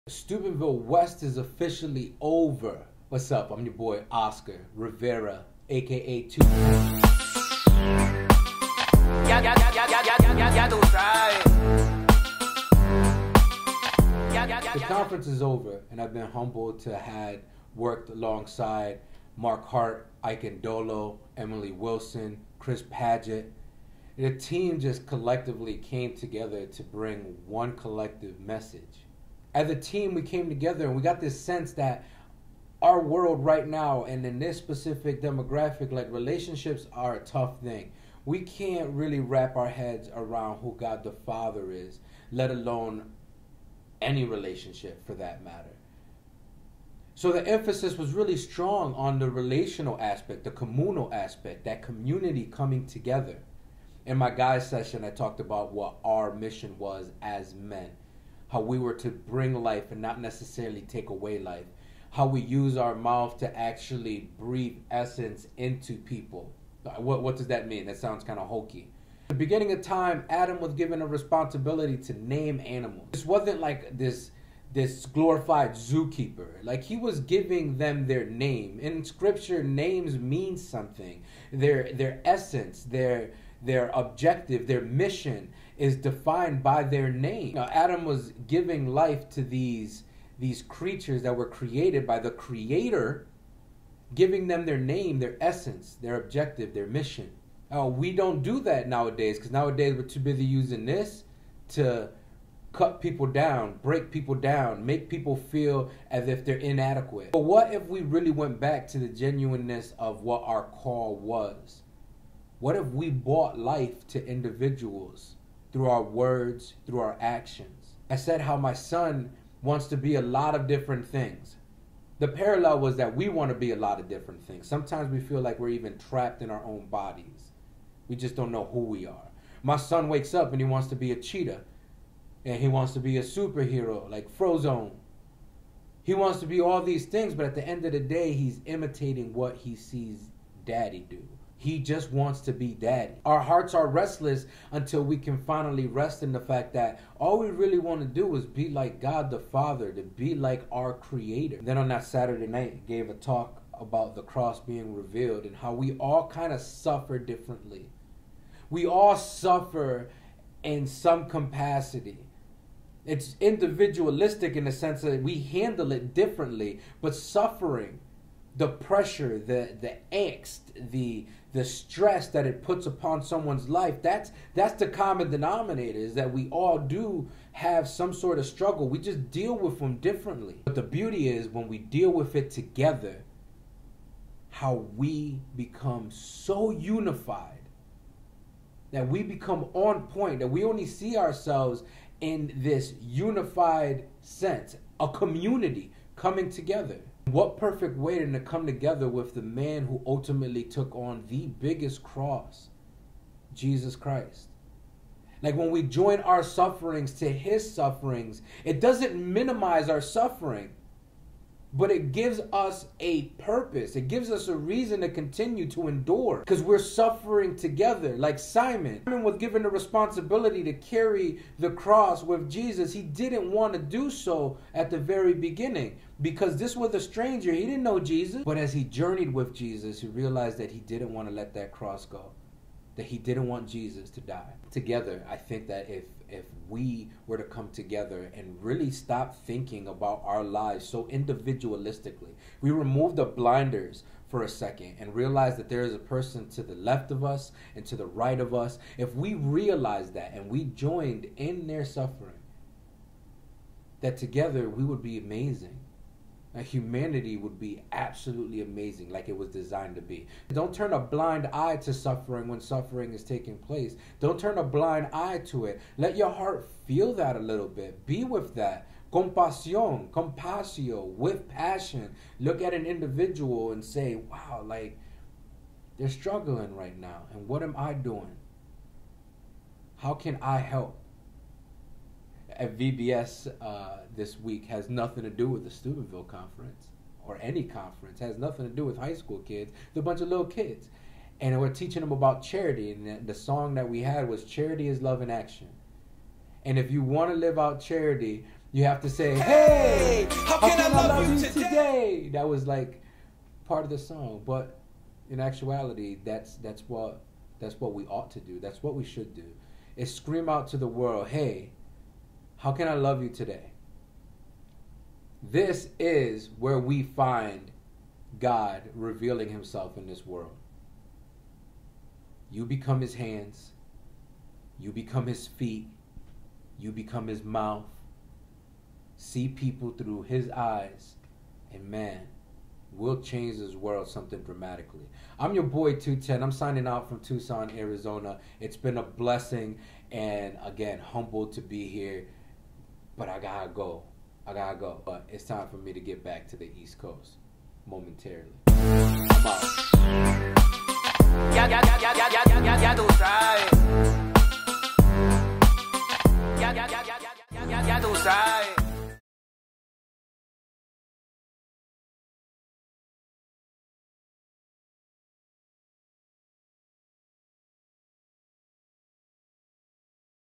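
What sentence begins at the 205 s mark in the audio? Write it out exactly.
Like when we join our sufferings to his sufferings, it doesn't minimize our suffering but it gives us a purpose.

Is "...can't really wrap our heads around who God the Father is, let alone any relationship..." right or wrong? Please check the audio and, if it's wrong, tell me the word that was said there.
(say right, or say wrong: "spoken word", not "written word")
right.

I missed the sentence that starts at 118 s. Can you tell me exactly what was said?
I said how my son wants to be a lot of different things.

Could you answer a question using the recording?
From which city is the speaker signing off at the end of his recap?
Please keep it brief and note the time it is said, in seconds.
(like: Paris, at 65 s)
Tucson, Arizona, at 337 s.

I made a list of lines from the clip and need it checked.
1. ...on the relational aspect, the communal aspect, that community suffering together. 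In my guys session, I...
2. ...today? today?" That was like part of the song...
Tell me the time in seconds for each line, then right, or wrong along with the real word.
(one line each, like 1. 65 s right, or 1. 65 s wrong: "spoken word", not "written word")
1. 48 s wrong: "coming", not "suffering"
2. 301 s right.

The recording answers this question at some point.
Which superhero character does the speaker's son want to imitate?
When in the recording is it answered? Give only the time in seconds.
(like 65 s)
134 s.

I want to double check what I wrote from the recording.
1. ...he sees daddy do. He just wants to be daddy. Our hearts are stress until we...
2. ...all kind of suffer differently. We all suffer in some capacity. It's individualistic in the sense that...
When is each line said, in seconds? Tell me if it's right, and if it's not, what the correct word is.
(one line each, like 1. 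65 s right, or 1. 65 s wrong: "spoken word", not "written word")
1. 139 s wrong: "restless", not "stress"
2. 155 s right.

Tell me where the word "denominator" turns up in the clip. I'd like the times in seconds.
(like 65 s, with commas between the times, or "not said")
175 s.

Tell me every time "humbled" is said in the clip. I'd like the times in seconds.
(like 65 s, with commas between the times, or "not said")
16 s, 340 s.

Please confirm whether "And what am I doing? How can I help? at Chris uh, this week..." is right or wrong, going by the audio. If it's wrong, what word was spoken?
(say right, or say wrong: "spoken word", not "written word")
wrong: "VBS", not "Chris".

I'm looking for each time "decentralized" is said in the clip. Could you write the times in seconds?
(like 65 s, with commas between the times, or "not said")
not said.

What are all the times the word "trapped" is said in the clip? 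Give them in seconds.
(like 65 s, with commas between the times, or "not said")
125 s.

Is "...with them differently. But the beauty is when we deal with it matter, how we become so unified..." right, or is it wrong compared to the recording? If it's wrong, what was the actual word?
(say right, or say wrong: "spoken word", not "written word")
wrong: "together", not "matter".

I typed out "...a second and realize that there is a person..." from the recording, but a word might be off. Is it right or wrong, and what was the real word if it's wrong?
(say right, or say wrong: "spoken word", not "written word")
right.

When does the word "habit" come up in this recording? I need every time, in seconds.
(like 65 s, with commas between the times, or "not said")
not said.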